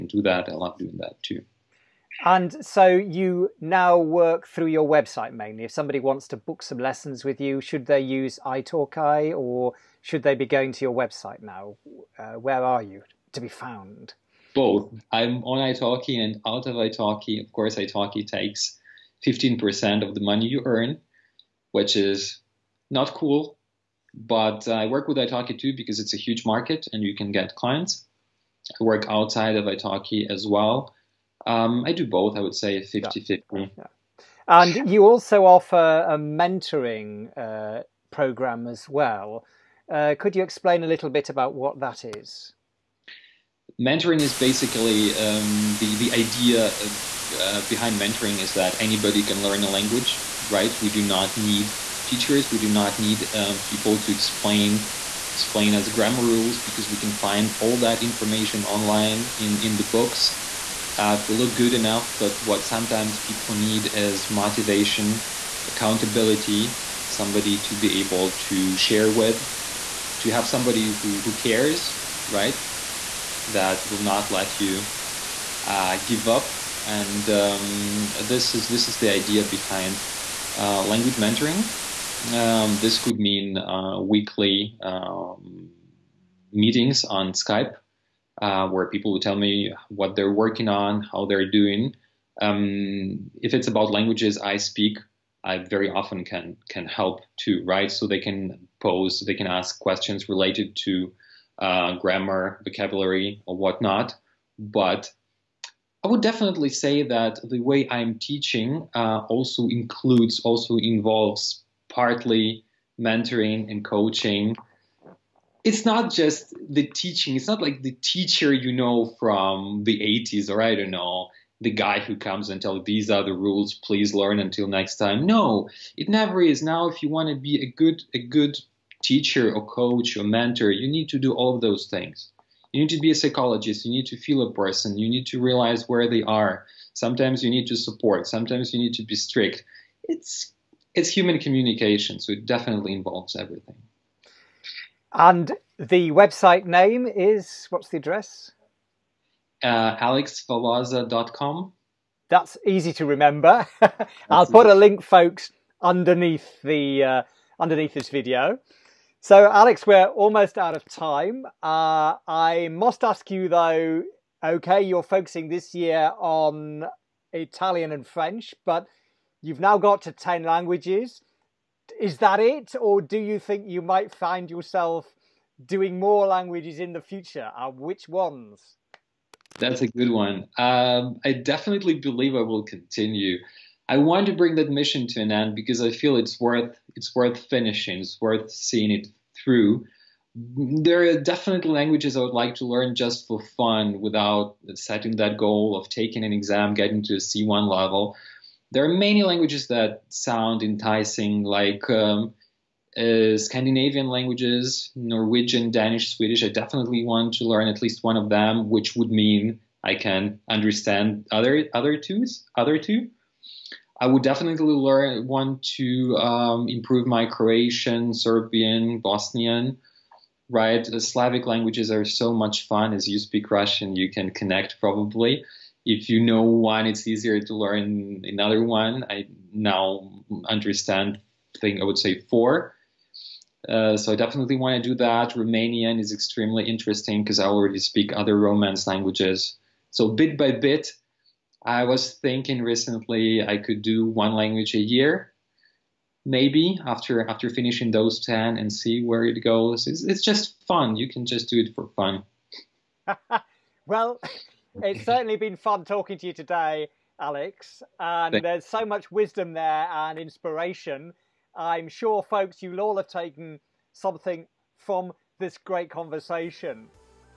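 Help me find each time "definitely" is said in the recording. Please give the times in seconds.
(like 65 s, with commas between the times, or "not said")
106 s, 142 s, 181 s, 191 s, 206 s, 214 s, 234 s.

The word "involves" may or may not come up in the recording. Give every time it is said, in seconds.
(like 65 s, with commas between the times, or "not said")
110 s, 142 s.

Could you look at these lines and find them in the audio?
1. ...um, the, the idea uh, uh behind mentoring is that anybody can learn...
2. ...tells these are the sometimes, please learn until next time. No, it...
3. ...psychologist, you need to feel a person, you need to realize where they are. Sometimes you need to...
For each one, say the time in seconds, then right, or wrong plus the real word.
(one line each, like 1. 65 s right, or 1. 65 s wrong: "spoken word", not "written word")
1. 45 s right
2. 122 s wrong: "rules", not "sometimes"
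3. 133 s right.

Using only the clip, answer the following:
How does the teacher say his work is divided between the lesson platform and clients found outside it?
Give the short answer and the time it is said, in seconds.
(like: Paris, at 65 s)
50 50, at 32 s.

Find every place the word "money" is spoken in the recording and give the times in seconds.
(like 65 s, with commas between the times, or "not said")
20 s.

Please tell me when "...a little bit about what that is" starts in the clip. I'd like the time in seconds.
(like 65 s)
40 s.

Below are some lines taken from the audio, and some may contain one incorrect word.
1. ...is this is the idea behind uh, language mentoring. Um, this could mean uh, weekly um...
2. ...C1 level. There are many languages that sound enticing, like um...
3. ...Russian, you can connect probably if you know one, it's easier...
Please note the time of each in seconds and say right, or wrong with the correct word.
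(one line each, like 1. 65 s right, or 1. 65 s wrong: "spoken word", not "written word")
1. 78 s right
2. 197 s right
3. 223 s right.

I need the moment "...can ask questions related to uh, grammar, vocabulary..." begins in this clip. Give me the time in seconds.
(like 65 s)
99 s.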